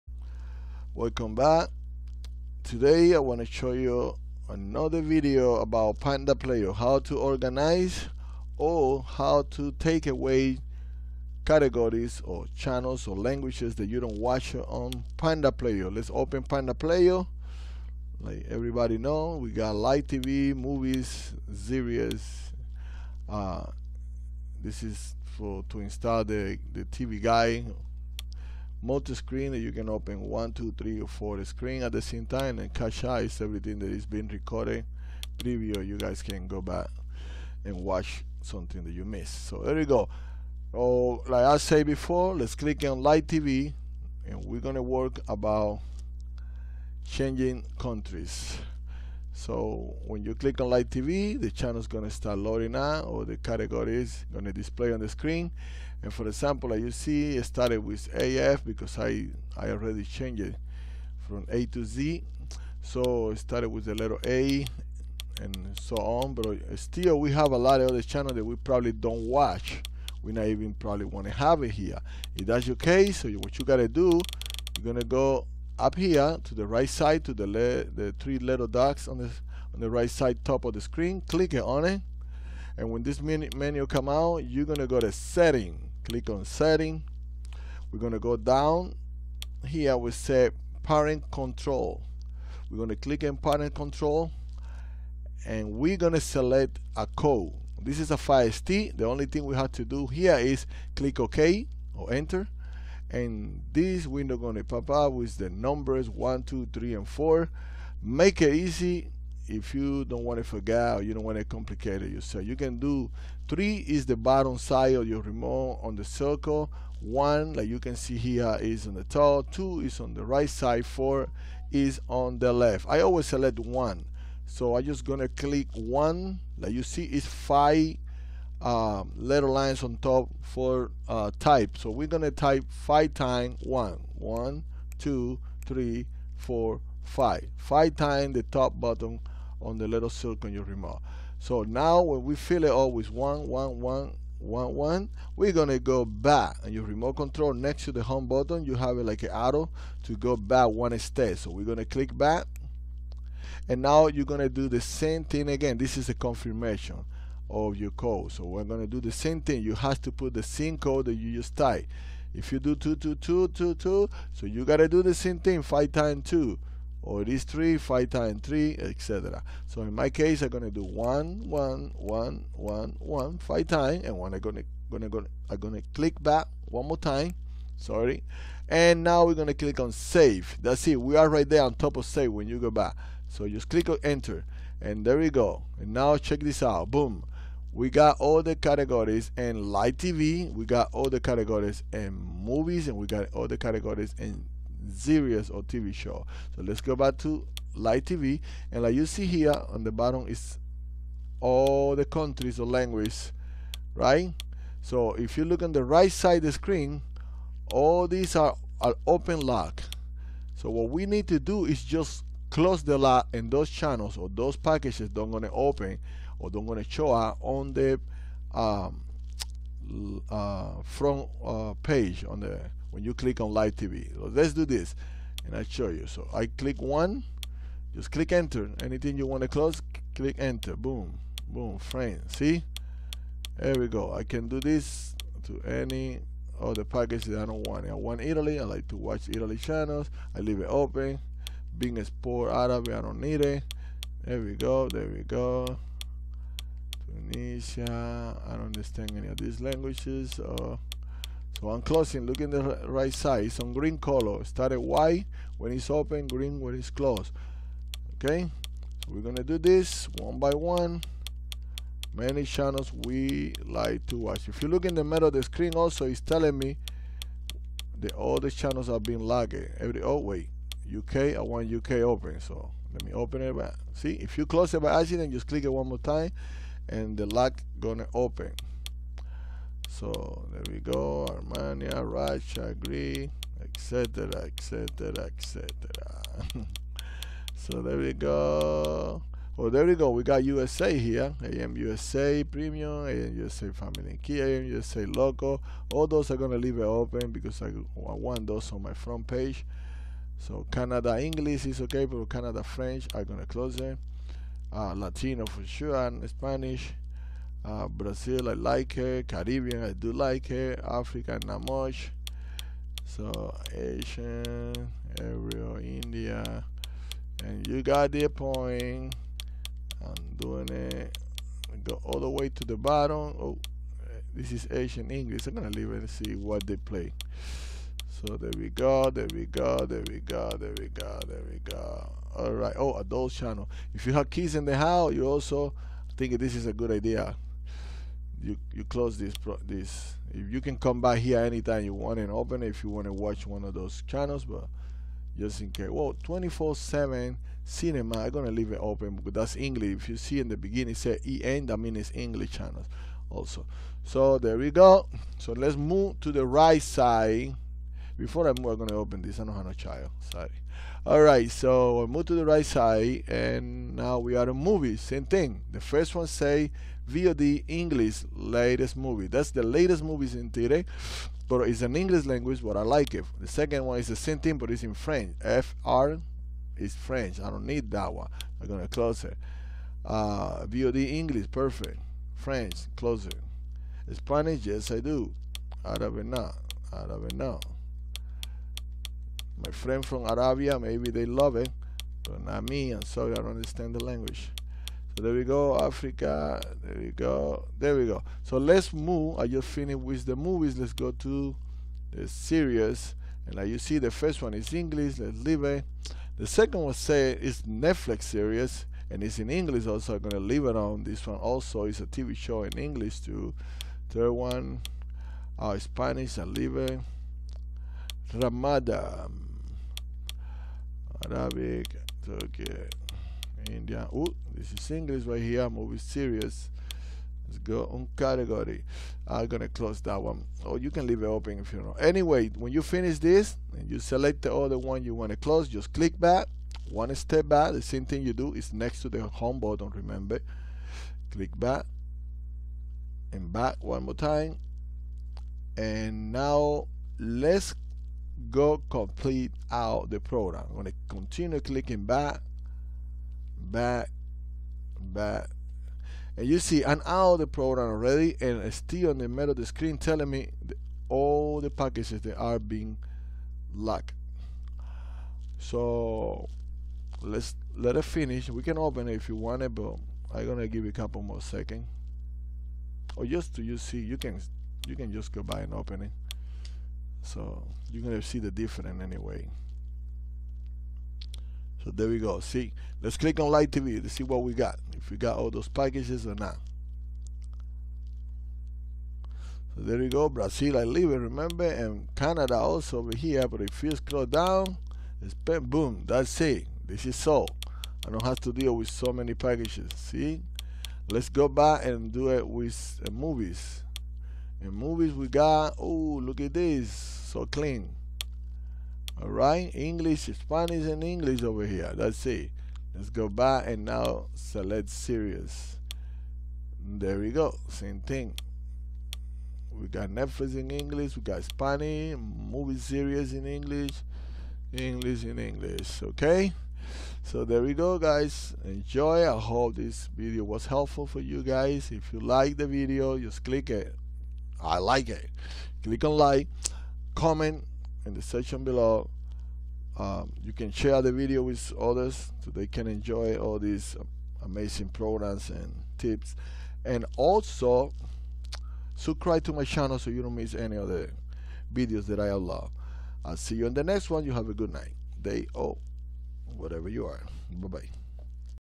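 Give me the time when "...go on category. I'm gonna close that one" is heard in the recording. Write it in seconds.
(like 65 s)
427 s.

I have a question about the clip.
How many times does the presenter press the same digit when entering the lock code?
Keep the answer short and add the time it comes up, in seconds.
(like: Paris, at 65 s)
5, at 132 s.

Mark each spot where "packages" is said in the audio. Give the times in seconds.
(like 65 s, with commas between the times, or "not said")
214 s, 236 s, 461 s, 485 s, 499 s.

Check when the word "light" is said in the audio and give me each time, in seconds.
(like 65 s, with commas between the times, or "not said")
43 s, 50 s, 483 s.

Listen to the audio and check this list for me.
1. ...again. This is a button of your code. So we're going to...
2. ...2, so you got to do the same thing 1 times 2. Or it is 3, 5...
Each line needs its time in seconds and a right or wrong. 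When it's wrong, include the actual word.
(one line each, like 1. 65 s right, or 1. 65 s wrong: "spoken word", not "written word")
1. 155 s wrong: "confirmation", not "button"
2. 163 s wrong: "5", not "1".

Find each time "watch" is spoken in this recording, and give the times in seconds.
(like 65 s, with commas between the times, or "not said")
14 s, 37 s, 69 s, 238 s, 264 s, 343 s.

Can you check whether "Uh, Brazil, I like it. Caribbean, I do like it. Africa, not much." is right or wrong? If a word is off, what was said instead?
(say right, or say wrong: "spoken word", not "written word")
right.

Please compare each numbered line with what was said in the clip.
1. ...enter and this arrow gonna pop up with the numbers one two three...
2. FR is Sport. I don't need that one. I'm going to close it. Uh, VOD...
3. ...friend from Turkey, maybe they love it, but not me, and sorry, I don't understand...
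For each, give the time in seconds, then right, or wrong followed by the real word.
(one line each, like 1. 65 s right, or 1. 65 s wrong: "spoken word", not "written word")
1. 102 s wrong: "window", not "arrow"
2. 375 s wrong: "French", not "Sport"
3. 389 s wrong: "Arabia", not "Turkey".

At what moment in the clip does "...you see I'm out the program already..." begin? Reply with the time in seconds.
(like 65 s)
456 s.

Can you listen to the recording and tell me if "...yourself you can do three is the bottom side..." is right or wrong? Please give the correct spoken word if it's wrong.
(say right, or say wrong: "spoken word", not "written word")
right.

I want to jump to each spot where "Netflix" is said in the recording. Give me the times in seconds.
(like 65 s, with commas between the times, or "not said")
407 s, 520 s.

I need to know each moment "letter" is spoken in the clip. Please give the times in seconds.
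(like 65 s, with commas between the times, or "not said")
63 s, 129 s.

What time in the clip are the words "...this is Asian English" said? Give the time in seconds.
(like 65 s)
324 s.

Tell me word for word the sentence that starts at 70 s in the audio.
We not even probably want to have it here.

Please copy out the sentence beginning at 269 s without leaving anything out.
Every, oh wait, UK, I want UK open.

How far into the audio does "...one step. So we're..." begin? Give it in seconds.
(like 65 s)
150 s.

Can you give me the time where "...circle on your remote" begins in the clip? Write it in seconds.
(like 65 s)
140 s.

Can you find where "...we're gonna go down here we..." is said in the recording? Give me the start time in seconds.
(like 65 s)
87 s.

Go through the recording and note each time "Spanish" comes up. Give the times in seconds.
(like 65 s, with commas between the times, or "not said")
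306 s, 384 s, 415 s, 510 s, 521 s.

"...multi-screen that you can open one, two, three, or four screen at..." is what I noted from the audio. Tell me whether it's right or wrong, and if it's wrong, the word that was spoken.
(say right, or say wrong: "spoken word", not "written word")
right.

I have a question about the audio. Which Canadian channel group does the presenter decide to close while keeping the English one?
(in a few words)
Canada French.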